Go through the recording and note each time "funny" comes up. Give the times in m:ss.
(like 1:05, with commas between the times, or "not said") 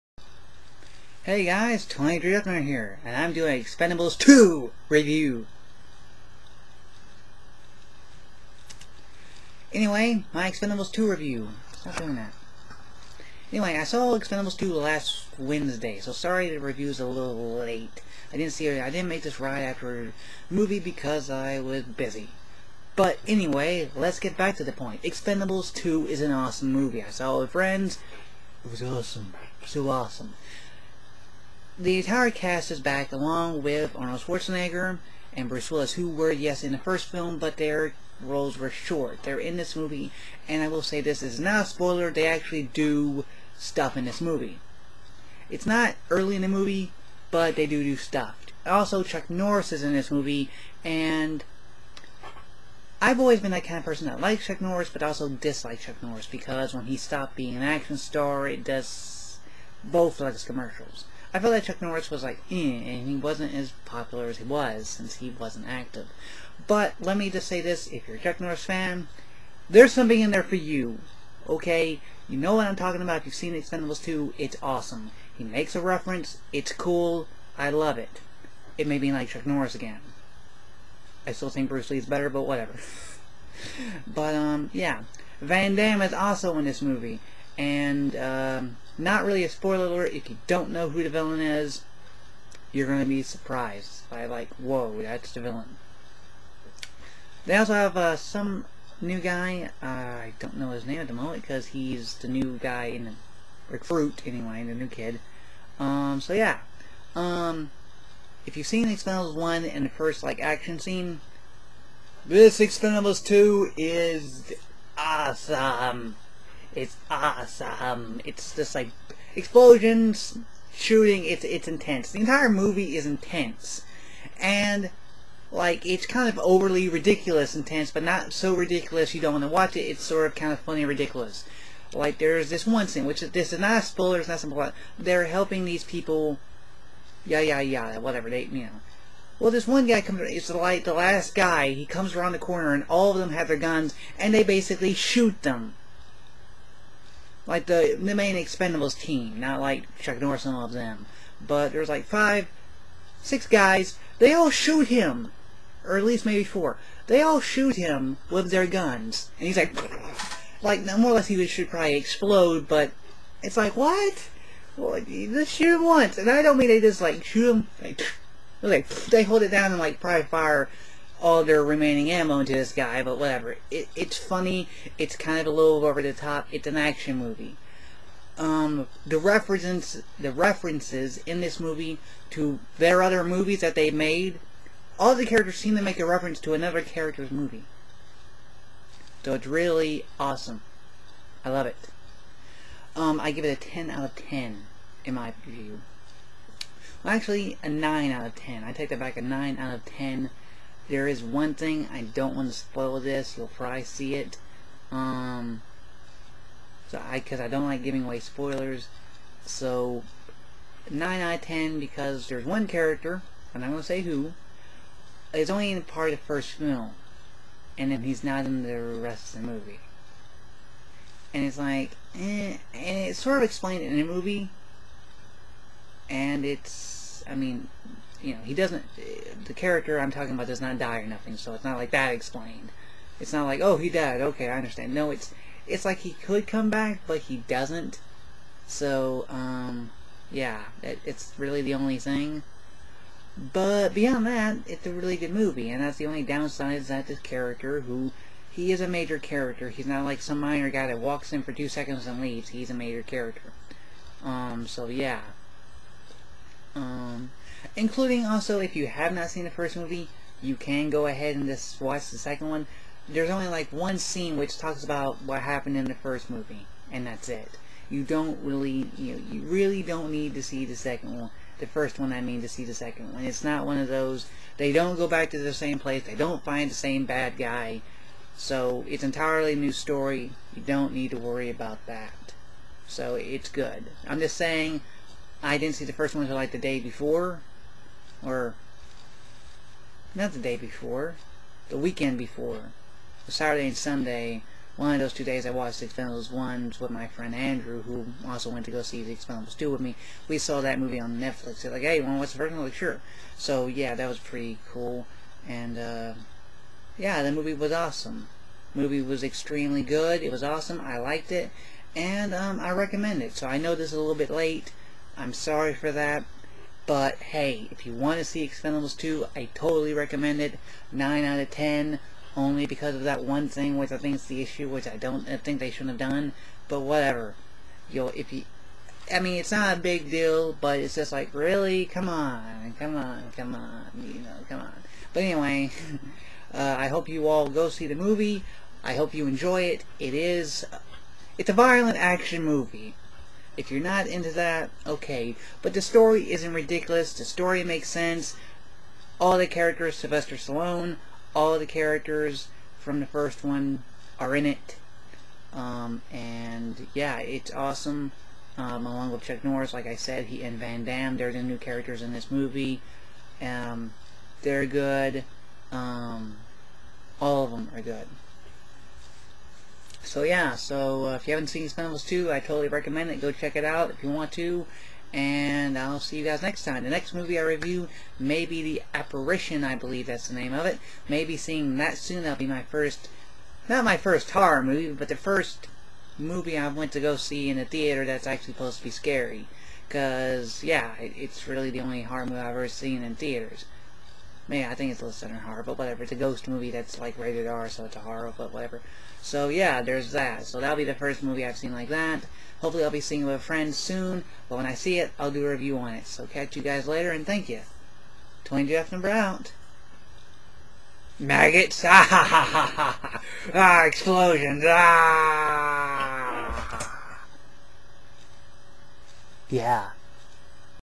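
2:10, 2:54.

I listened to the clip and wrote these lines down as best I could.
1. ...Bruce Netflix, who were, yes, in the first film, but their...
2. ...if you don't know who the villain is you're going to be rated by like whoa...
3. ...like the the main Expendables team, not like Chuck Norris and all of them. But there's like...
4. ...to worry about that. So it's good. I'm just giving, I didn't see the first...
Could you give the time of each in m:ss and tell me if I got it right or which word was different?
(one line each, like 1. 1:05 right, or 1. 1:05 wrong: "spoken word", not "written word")
1. 0:35 wrong: "Willis", not "Netflix"
2. 1:30 wrong: "surprised", not "rated"
3. 2:27 right
4. 4:41 wrong: "saying", not "giving".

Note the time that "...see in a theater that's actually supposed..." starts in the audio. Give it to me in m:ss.
6:27.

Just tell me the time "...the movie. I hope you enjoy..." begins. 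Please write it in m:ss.
5:37.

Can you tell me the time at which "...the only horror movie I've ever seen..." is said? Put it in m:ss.
6:31.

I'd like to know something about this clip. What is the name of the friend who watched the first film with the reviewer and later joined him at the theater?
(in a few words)
Andrew.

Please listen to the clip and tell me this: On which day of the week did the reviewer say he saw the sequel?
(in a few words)
Wednesday.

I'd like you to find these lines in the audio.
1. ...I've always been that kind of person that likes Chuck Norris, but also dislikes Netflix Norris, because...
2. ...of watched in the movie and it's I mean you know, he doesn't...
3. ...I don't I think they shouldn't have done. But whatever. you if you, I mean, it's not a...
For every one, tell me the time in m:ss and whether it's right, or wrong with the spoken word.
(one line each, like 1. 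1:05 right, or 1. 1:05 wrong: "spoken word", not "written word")
1. 0:53 wrong: "Chuck", not "Netflix"
2. 3:43 wrong: "explained", not "watched"
3. 5:24 right.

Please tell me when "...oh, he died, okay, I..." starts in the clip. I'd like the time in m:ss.
3:53.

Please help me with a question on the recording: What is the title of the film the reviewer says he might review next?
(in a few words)
The Apparition.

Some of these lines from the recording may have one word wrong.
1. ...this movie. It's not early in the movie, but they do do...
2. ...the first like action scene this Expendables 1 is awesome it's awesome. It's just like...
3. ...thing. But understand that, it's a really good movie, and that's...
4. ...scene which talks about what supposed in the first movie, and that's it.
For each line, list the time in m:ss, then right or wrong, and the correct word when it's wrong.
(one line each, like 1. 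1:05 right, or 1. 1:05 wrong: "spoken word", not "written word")
1. 0:44 right
2. 1:49 wrong: "2", not "1"
3. 4:01 wrong: "beyond", not "understand"
4. 4:23 wrong: "happened", not "supposed".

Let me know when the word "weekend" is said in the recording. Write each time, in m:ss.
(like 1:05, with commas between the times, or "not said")
4:51.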